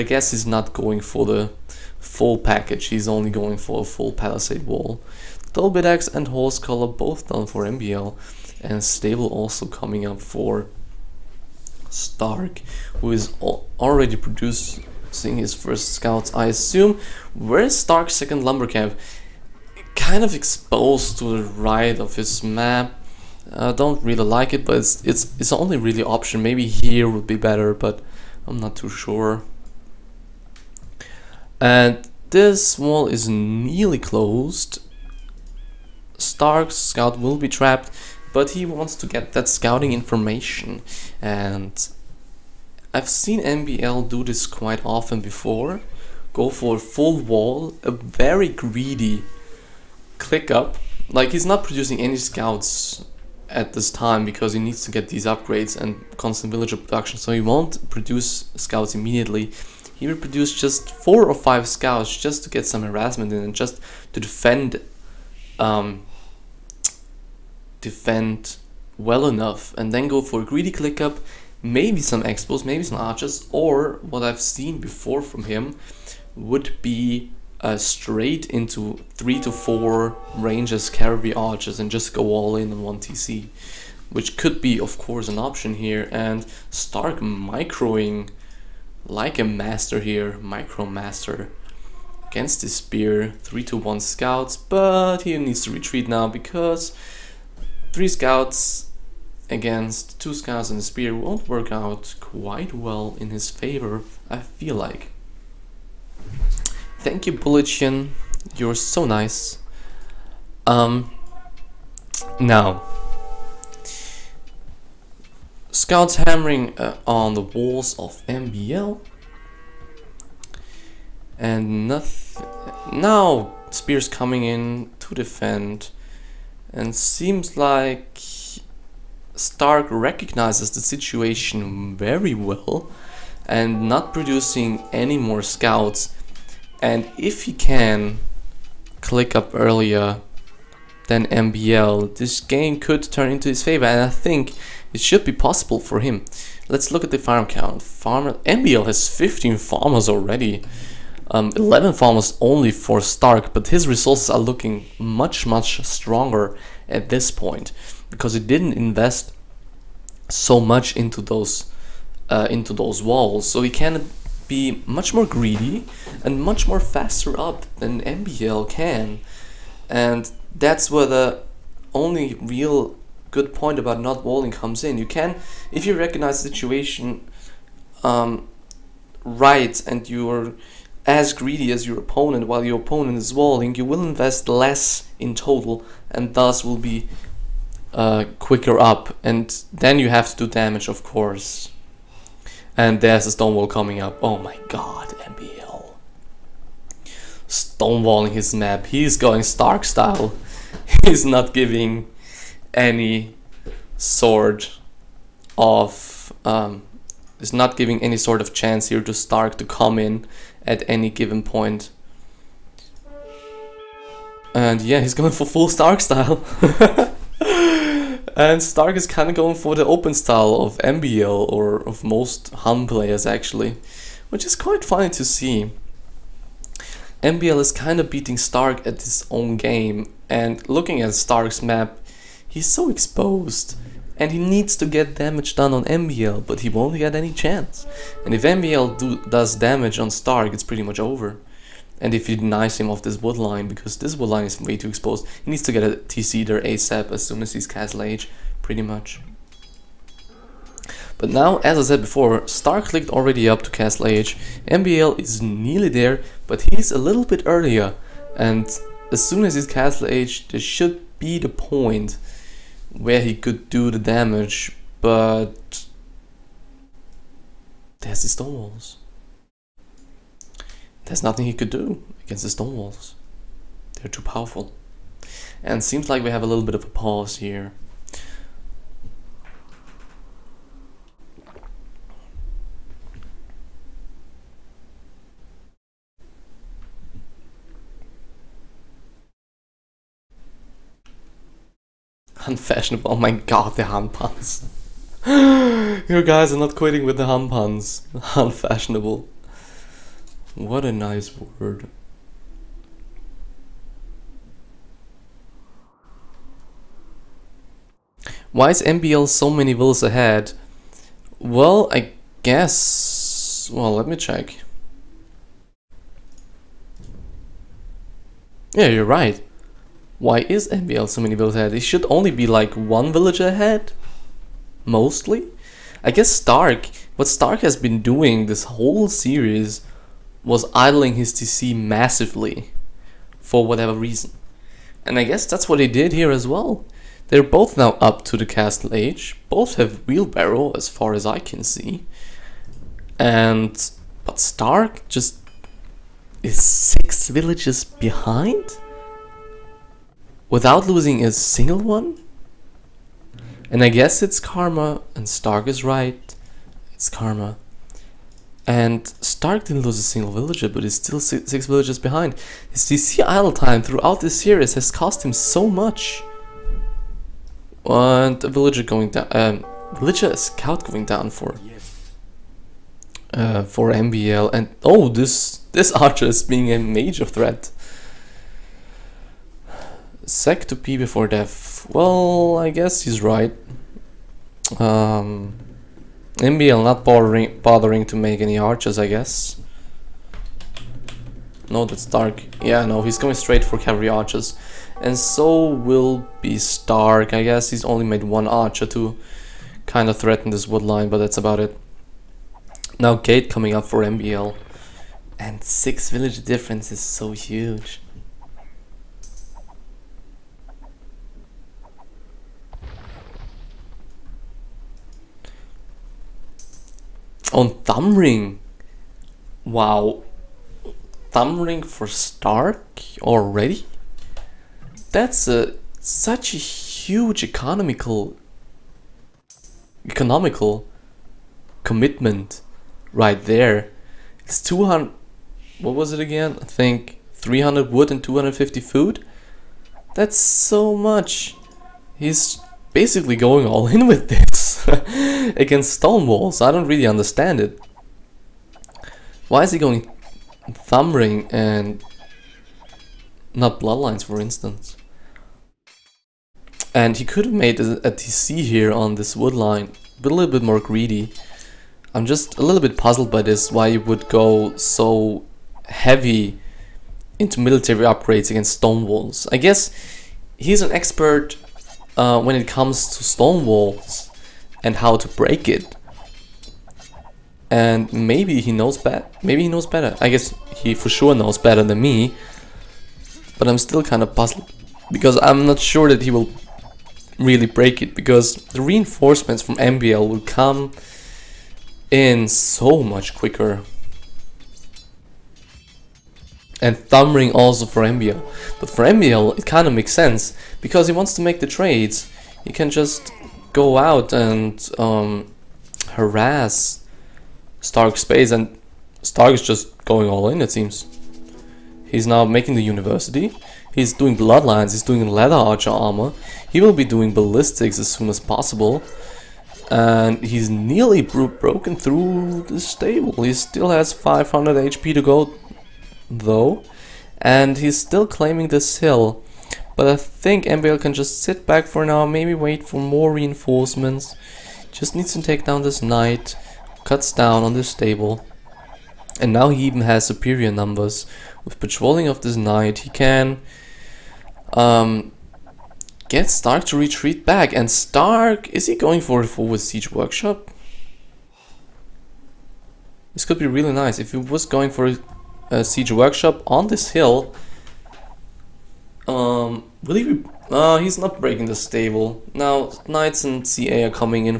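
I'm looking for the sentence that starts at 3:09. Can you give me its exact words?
And then you have to do damage, of course.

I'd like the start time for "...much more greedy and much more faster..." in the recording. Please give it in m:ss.
2:44.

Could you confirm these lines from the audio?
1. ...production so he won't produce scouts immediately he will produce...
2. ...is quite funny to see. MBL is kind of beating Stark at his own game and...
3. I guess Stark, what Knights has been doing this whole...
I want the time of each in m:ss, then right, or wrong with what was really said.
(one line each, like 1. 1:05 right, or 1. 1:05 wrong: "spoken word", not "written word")
1. 0:56 right
2. 3:44 right
3. 5:26 wrong: "Stark", not "Knights".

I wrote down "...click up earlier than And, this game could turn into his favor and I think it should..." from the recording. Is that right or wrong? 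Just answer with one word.
wrong.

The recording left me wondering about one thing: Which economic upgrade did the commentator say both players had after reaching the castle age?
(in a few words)
Wheelbarrow.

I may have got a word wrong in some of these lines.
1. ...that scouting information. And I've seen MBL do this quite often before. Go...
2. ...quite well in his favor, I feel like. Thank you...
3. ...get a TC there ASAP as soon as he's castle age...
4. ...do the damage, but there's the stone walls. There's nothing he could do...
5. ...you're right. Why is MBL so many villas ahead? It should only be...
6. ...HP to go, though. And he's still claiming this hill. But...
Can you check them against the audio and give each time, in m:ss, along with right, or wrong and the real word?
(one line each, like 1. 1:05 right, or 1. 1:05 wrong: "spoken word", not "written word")
1. 0:39 right
2. 1:42 right
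3. 4:05 right
4. 4:23 right
5. 5:18 right
6. 8:44 right.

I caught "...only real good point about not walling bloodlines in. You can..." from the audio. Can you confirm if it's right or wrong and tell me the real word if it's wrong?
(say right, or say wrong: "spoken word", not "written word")
wrong: "comes", not "bloodlines".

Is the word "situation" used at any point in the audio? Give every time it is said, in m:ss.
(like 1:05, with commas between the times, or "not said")
2:10, 2:56.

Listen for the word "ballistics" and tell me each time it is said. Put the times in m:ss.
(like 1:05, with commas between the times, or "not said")
8:37.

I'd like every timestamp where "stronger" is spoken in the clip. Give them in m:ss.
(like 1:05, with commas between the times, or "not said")
2:35.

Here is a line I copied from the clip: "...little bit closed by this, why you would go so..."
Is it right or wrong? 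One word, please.
wrong.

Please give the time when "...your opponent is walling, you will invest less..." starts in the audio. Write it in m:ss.
3:02.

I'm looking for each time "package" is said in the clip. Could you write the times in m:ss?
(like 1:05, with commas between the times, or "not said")
0:02.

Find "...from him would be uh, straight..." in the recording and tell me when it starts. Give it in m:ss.
1:15.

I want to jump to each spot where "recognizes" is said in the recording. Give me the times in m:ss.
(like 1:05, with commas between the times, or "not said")
2:09, 2:55.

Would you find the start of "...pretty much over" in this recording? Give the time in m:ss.
4:00.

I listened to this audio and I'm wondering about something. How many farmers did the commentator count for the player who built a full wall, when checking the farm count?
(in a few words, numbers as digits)
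15.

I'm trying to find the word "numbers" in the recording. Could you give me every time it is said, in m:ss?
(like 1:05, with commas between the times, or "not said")
9:00.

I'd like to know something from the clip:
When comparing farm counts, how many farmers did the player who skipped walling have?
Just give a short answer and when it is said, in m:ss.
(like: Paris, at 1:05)
11, at 2:31.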